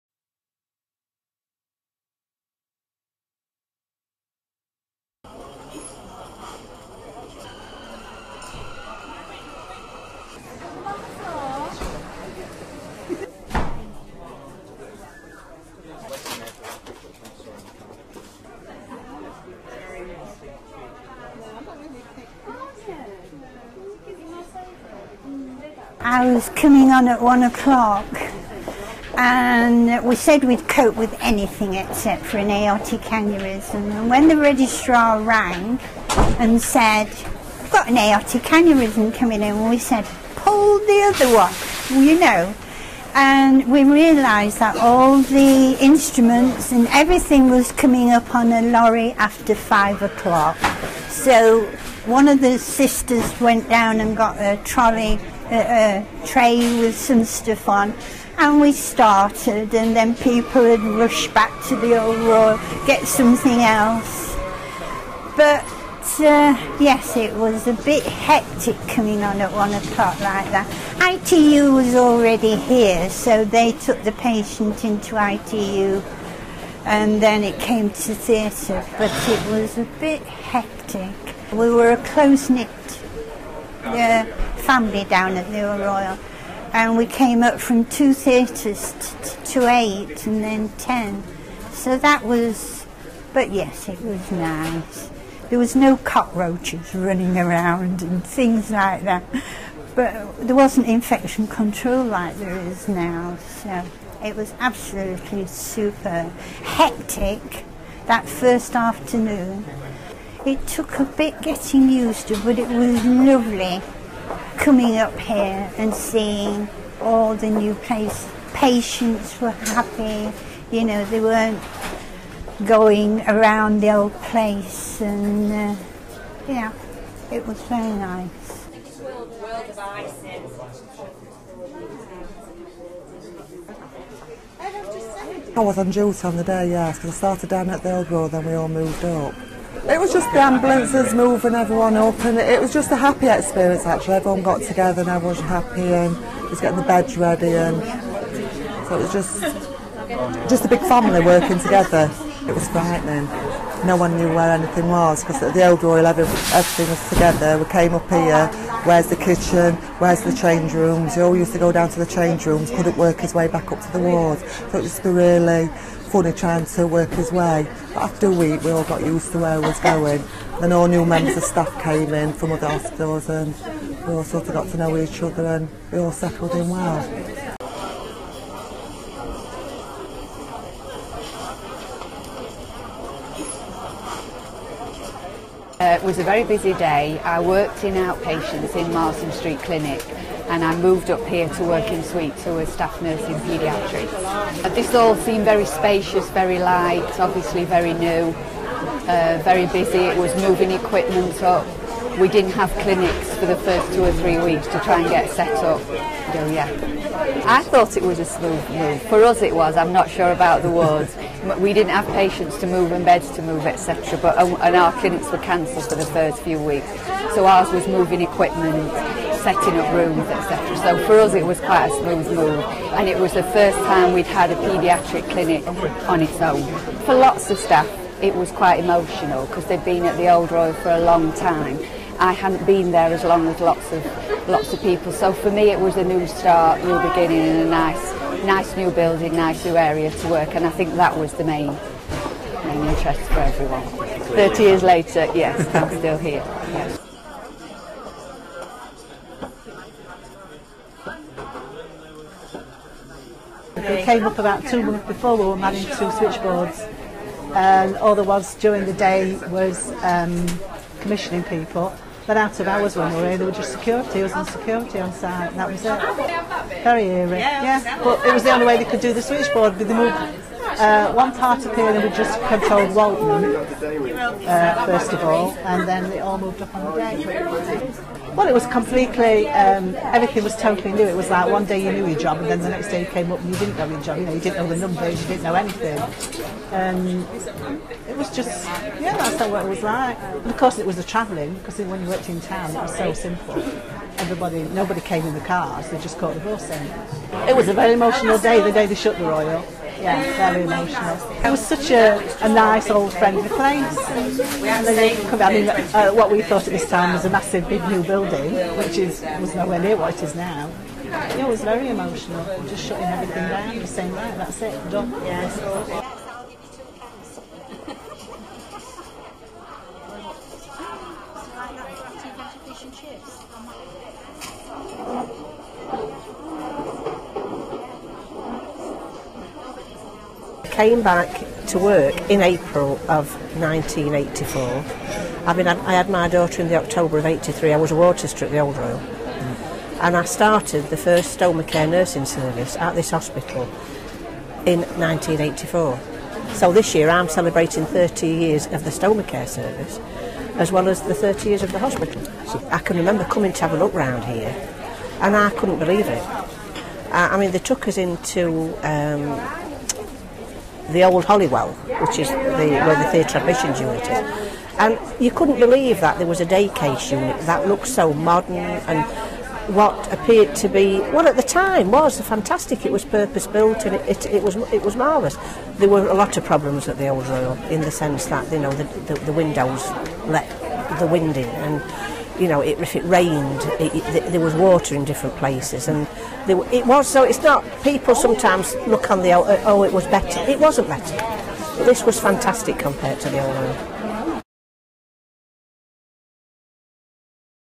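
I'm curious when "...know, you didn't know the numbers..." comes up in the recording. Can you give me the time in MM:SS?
04:44.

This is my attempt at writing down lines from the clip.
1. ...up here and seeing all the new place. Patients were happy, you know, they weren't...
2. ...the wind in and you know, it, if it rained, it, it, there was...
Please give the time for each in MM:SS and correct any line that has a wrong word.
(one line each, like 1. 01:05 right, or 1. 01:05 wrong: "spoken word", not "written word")
1. 01:54 right
2. 06:20 right.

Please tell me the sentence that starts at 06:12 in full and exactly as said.
It was purpose built and it, it, it was it was marvellous.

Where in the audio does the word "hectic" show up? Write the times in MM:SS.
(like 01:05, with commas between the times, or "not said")
01:08, 01:20, 01:46.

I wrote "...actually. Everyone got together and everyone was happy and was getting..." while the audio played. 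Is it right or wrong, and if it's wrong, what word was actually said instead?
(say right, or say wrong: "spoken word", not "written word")
right.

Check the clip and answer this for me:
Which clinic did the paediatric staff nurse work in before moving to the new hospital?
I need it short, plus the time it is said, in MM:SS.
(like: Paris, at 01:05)
Marsden Street Clinic, at 03:08.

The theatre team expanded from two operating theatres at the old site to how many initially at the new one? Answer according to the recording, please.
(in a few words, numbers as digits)
8.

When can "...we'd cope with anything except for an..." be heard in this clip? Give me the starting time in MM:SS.
00:30.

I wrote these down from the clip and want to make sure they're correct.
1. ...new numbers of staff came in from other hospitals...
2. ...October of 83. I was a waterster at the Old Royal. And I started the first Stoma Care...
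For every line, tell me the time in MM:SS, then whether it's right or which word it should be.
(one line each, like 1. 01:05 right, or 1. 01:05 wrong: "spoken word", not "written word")
1. 02:50 wrong: "members", not "numbers"
2. 05:36 right.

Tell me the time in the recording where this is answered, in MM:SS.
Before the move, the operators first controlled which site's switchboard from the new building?
04:32.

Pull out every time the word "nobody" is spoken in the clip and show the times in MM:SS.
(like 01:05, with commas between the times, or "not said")
04:54.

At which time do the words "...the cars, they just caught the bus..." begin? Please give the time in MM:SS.
04:55.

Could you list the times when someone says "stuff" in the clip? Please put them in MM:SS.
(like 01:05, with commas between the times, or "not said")
00:57.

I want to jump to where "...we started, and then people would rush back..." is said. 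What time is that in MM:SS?
00:58.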